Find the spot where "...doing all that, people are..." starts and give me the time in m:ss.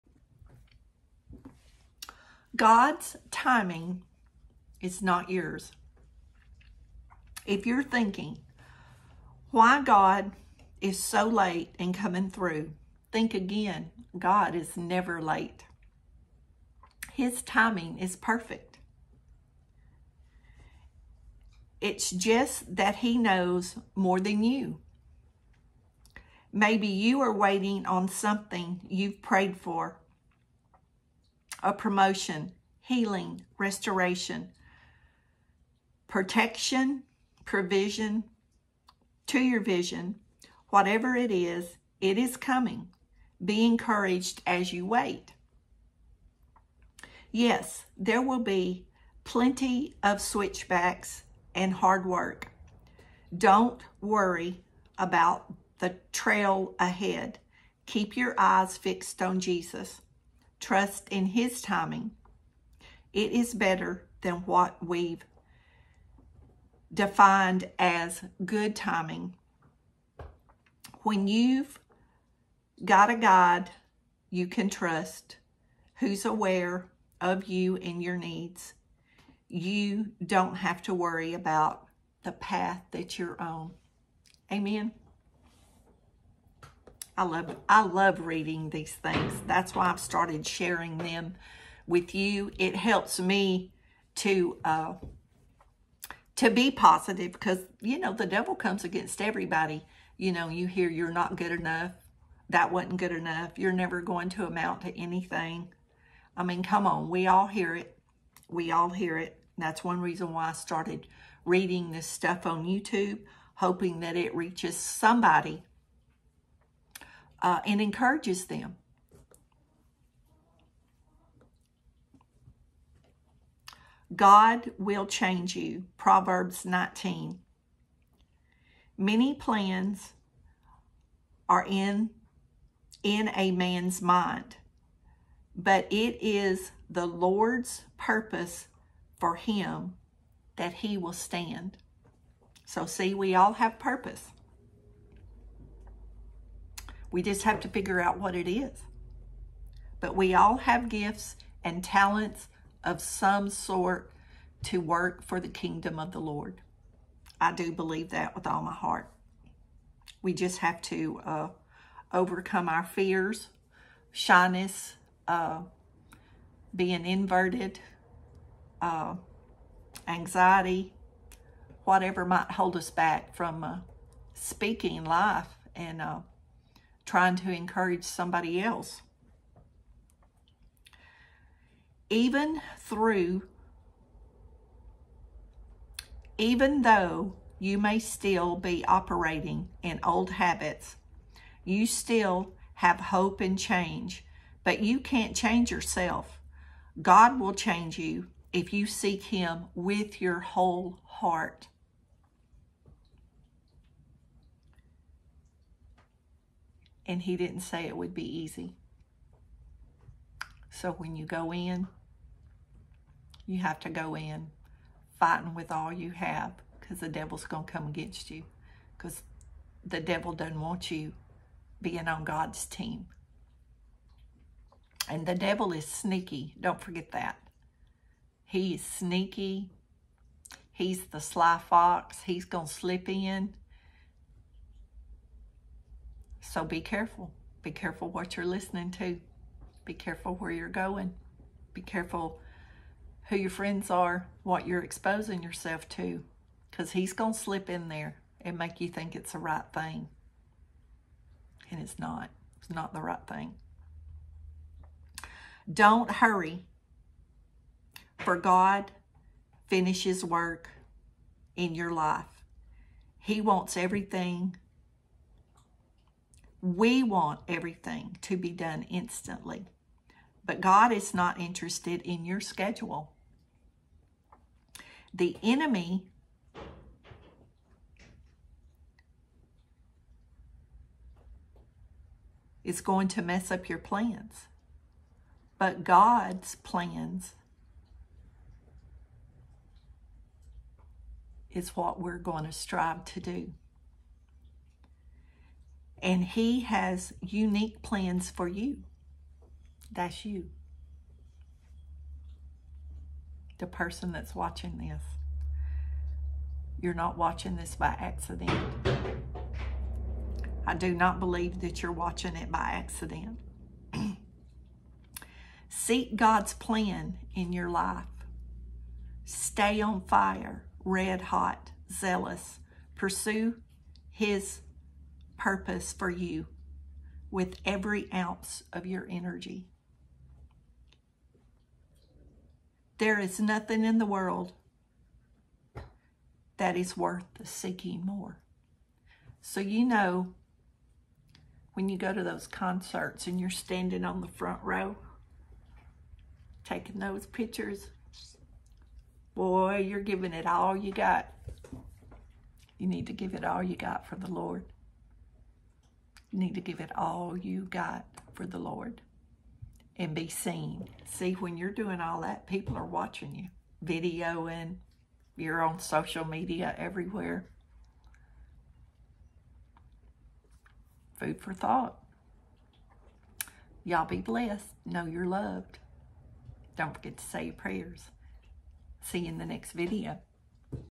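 6:01.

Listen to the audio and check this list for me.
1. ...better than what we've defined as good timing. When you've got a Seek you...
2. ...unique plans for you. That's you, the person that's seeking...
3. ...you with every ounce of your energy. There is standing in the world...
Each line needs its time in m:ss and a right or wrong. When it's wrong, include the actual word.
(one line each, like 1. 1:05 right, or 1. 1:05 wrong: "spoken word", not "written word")
1. 1:03 wrong: "God", not "Seek"
2. 4:57 wrong: "watching", not "seeking"
3. 5:26 wrong: "nothing", not "standing".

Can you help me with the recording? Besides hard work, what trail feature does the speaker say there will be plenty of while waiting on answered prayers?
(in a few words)
switchbacks.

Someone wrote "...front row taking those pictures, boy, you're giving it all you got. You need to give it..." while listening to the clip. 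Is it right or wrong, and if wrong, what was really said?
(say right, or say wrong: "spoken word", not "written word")
right.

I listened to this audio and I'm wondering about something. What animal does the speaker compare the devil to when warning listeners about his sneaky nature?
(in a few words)
sly fox.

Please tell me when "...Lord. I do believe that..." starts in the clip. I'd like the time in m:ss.
2:36.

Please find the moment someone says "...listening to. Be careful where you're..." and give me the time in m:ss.
3:58.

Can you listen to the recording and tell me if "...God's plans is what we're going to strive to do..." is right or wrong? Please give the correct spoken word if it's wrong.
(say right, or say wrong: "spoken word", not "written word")
right.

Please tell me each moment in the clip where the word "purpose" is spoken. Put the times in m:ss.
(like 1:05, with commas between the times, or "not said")
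2:17, 2:23, 5:25.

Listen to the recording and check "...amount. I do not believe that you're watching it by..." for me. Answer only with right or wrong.
wrong.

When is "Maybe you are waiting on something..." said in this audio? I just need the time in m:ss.
0:26.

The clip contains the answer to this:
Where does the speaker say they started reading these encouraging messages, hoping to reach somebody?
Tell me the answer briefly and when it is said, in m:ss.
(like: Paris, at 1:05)
YouTube, at 1:52.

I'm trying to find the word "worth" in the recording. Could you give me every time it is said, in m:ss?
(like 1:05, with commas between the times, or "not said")
5:36.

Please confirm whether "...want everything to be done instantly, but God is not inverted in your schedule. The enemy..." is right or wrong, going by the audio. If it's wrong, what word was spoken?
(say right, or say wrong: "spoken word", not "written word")
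wrong: "interested", not "inverted".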